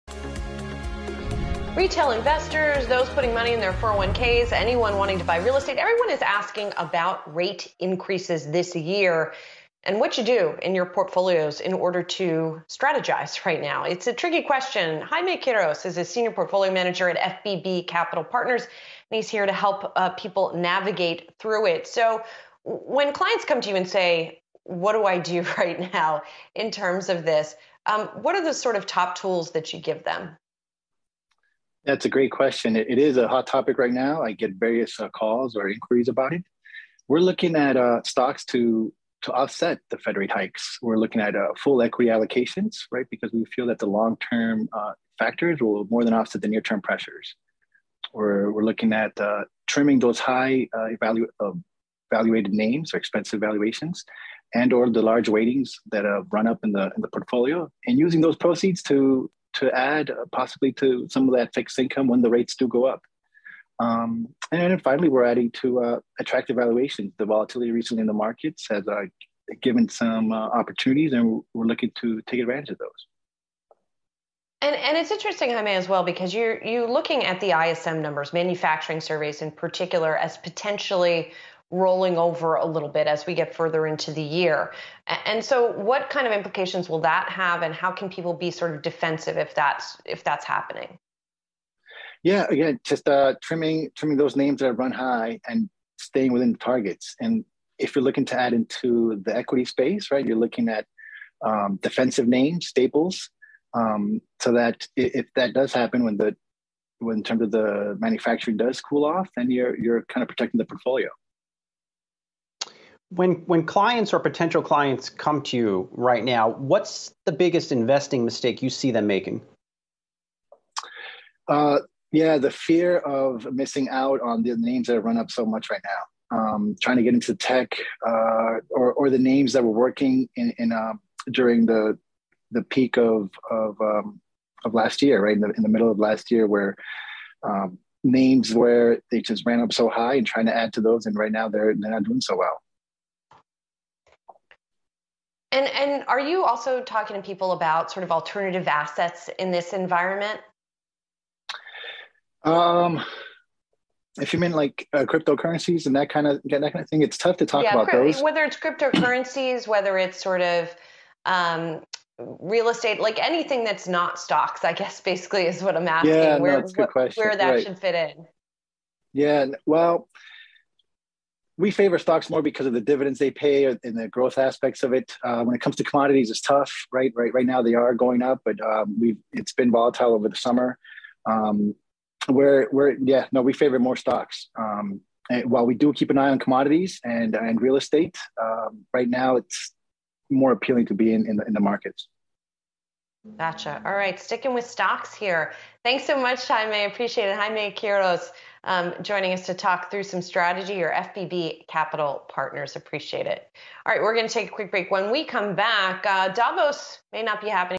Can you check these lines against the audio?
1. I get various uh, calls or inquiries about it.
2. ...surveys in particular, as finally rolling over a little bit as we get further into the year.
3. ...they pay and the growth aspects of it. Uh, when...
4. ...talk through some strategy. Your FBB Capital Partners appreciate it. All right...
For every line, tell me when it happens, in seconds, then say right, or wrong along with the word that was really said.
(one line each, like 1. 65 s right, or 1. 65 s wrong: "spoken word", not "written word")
1. 34 s right
2. 79 s wrong: "potentially", not "finally"
3. 173 s right
4. 199 s right.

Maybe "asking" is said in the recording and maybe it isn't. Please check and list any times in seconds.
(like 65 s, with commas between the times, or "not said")
6 s, 165 s.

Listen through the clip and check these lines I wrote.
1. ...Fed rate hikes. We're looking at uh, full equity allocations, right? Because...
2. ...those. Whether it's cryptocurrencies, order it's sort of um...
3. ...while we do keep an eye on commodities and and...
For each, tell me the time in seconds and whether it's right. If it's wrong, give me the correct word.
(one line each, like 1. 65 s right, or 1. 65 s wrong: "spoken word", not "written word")
1. 39 s right
2. 158 s wrong: "whether", not "order"
3. 185 s right.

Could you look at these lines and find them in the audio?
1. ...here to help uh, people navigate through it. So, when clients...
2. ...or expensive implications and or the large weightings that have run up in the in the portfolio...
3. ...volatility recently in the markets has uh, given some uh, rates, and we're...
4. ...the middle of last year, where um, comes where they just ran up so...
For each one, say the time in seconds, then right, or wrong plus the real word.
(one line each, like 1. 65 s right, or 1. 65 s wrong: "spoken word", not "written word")
1. 19 s right
2. 52 s wrong: "valuations", not "implications"
3. 67 s wrong: "opportunities", not "rates"
4. 135 s wrong: "names", not "comes".